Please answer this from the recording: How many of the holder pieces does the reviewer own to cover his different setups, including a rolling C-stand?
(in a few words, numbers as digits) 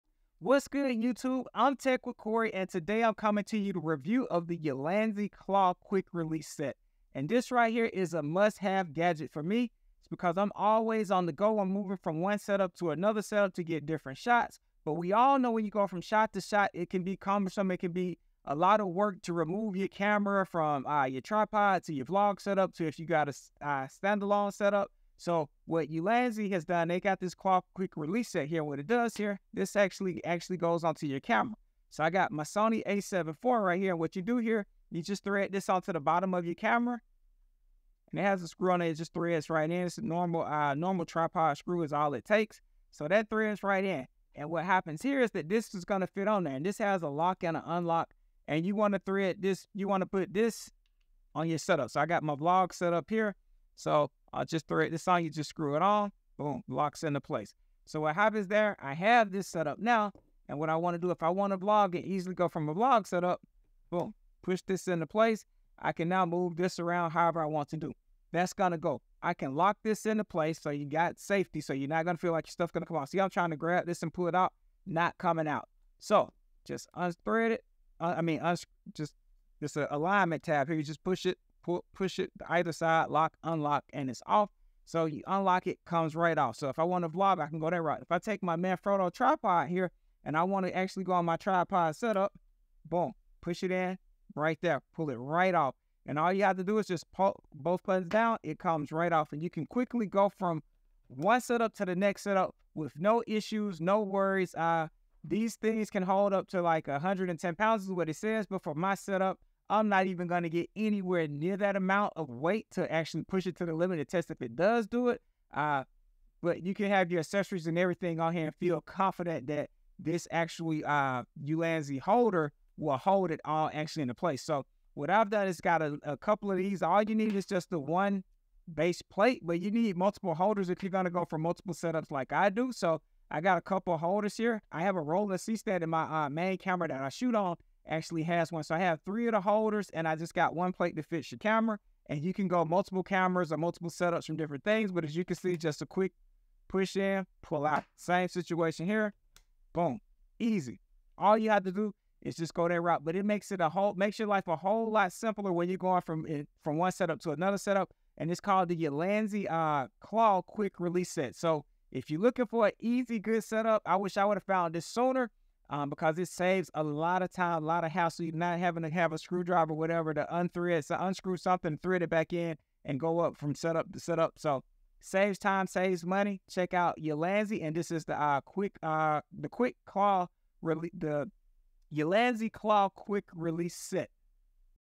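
3.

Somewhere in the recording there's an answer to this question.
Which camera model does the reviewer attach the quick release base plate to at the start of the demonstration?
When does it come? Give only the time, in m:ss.
0:32.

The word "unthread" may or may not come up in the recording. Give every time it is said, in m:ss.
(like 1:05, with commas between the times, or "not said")
1:16, 2:50.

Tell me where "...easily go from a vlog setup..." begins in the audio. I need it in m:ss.
1:02.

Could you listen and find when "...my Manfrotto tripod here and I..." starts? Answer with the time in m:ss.
1:28.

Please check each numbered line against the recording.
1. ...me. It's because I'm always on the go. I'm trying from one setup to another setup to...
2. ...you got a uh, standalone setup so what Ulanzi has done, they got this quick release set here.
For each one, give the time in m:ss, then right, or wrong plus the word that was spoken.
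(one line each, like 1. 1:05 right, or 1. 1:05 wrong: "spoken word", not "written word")
1. 0:09 wrong: "moving", not "trying"
2. 0:22 right.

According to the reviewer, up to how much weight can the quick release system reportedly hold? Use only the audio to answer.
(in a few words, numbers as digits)
110 pounds.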